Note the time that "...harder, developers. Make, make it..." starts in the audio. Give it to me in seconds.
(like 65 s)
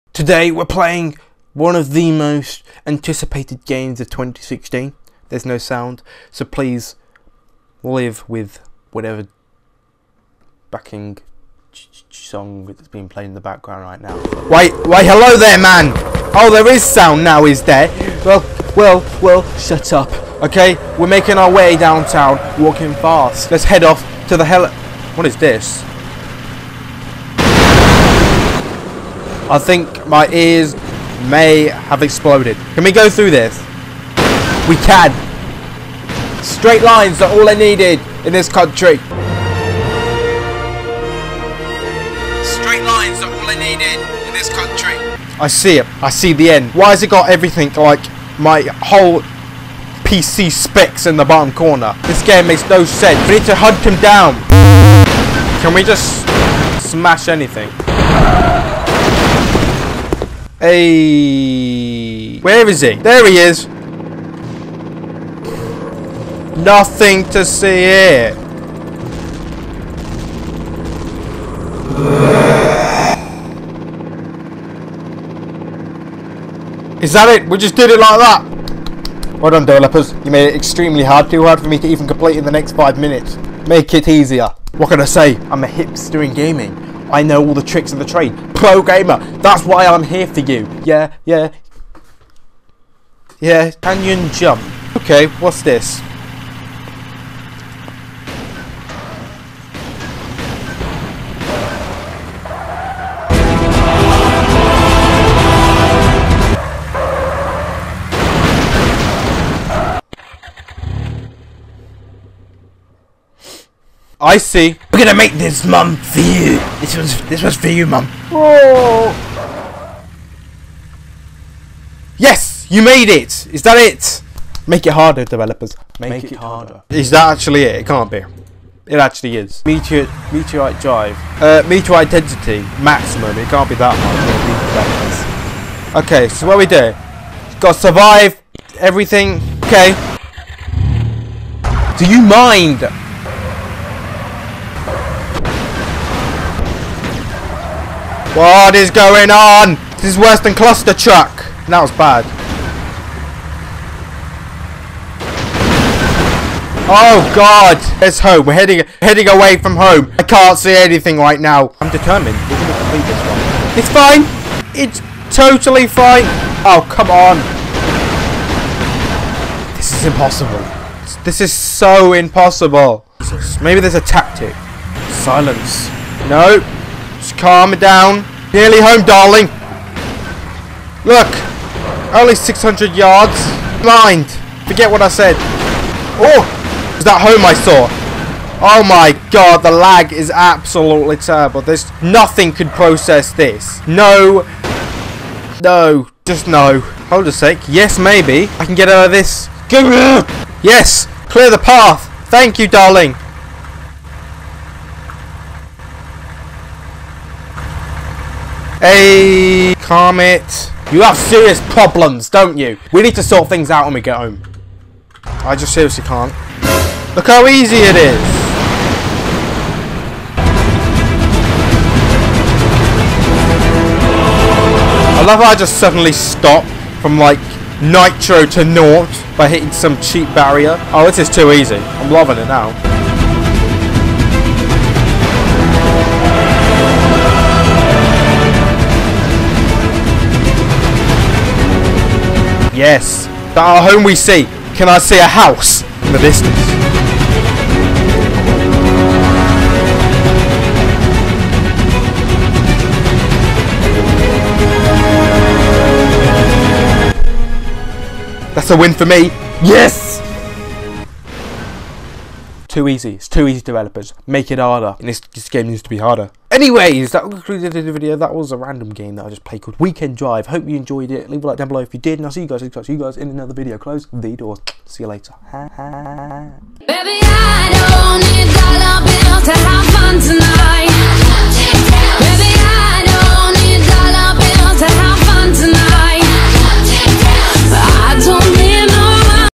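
124 s.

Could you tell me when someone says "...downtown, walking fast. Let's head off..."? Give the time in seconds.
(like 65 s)
21 s.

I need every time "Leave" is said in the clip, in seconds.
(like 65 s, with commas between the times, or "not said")
271 s.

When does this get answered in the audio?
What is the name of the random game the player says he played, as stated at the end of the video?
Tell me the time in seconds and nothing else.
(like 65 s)
269 s.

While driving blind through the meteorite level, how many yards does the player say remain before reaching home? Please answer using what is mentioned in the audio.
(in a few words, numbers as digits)
600.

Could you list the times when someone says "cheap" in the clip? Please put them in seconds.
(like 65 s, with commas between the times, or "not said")
230 s.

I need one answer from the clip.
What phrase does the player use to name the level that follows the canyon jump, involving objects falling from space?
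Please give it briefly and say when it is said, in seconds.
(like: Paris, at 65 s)
Meteorite drive, at 130 s.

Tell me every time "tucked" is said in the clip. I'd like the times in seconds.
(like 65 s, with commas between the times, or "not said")
not said.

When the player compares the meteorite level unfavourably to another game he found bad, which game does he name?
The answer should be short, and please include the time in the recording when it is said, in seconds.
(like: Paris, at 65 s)
Clustertruck, at 150 s.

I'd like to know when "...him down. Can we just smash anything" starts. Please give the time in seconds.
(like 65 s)
53 s.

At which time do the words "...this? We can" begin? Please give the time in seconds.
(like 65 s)
33 s.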